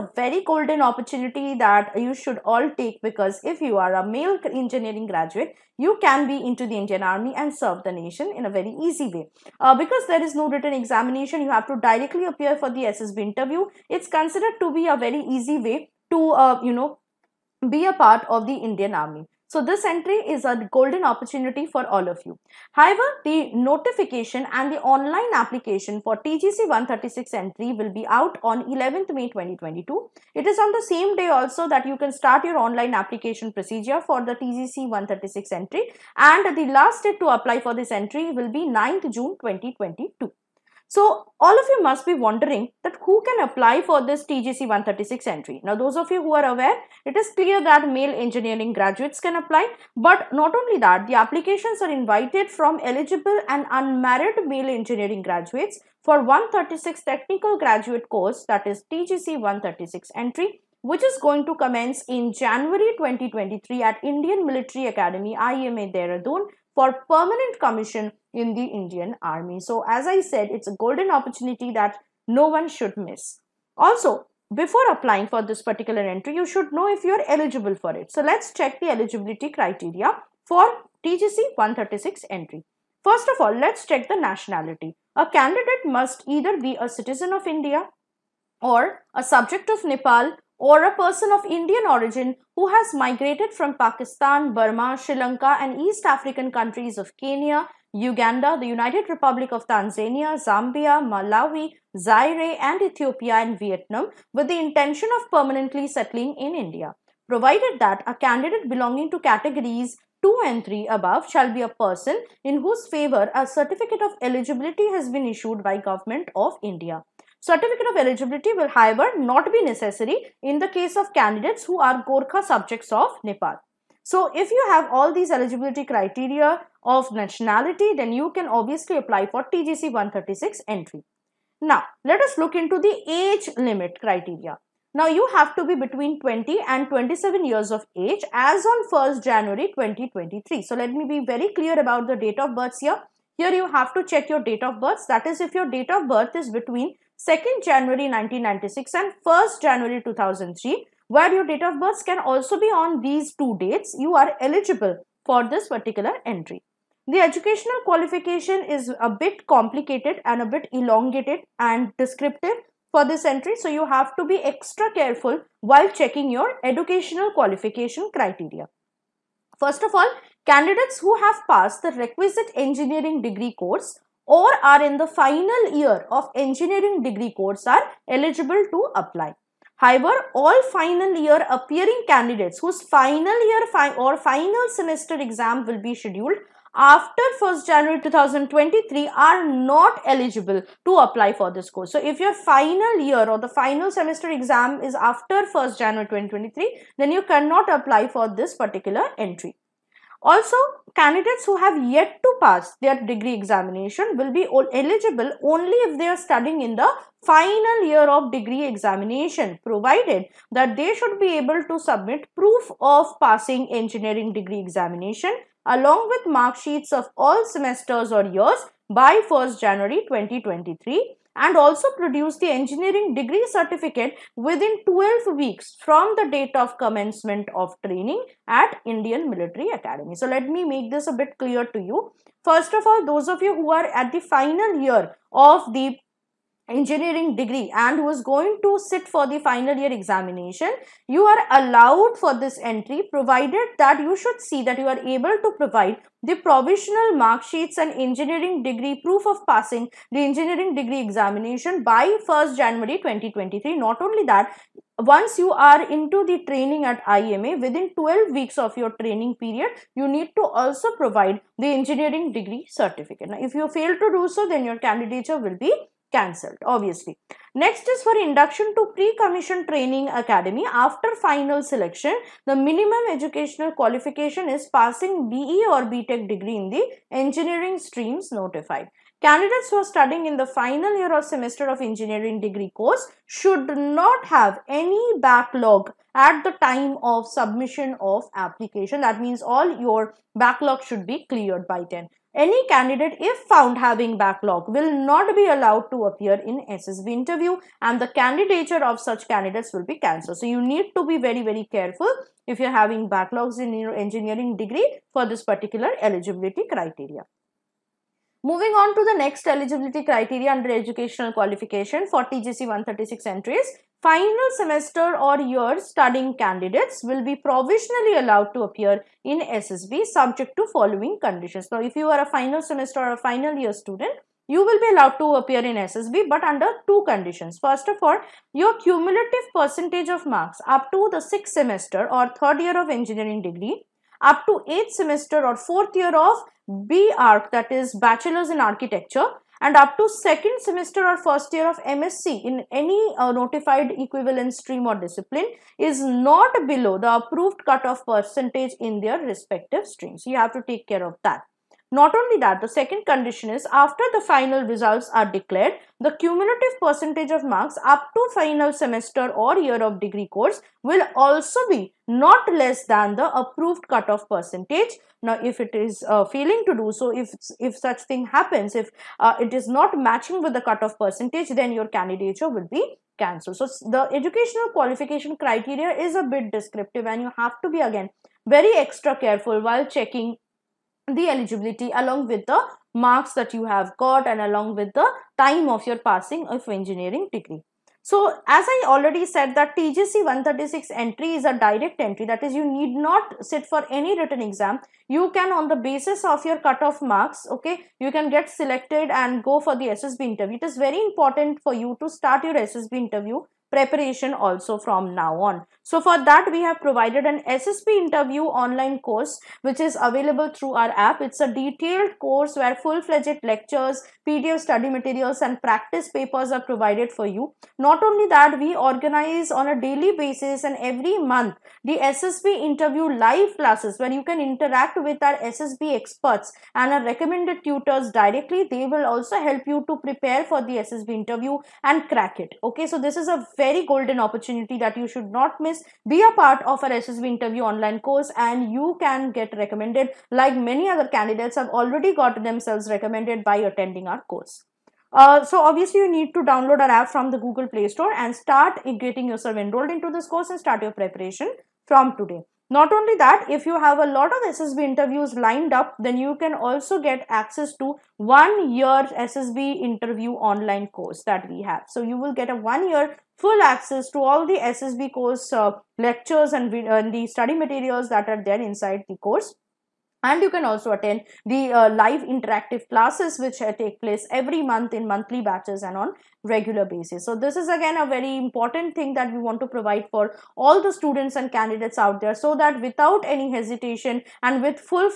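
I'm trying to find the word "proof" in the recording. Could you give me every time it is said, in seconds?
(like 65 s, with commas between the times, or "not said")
212 s, 249 s.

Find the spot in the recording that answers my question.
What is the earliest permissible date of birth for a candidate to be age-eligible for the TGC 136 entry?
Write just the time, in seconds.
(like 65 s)
147 s.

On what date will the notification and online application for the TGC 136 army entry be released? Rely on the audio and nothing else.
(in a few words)
11 May 2022.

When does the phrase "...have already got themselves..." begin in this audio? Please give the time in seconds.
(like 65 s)
441 s.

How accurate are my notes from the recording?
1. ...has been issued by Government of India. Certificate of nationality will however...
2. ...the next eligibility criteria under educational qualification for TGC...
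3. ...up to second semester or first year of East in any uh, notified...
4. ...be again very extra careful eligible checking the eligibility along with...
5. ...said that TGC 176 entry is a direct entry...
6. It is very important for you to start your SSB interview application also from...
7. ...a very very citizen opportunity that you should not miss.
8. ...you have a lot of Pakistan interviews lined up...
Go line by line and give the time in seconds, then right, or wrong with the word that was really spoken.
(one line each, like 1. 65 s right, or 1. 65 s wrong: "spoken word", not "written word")
1. 114 s wrong: "eligibility", not "nationality"
2. 309 s right
3. 339 s wrong: "MSc", not "East"
4. 377 s wrong: "while", not "eligible"
5. 389 s wrong: "136", not "176"
6. 400 s wrong: "preparation", not "application"
7. 433 s wrong: "golden", not "citizen"
8. 453 s wrong: "SSB", not "Pakistan".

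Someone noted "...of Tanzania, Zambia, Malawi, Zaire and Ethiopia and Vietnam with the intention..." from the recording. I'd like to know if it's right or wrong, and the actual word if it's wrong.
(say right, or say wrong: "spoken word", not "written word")
right.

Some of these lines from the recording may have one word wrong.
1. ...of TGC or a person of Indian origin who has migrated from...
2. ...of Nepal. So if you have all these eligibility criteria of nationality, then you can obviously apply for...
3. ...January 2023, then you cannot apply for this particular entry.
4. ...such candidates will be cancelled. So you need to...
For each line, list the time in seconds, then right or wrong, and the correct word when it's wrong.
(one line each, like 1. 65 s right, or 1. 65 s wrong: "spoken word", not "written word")
1. 89 s wrong: "Nepal", not "TGC"
2. 122 s right
3. 195 s right
4. 298 s right.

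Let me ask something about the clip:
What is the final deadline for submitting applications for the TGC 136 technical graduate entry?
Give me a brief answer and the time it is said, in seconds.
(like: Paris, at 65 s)
9 June 2022, at 38 s.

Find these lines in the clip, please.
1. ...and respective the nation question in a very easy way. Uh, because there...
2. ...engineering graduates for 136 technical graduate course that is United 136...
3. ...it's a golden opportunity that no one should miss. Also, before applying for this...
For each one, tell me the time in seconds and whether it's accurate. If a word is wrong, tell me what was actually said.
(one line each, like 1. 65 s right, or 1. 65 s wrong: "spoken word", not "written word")
1. 7 s wrong: "serve", not "respective"
2. 54 s wrong: "TGC", not "United"
3. 70 s right.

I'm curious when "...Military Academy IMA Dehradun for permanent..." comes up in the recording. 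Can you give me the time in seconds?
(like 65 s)
64 s.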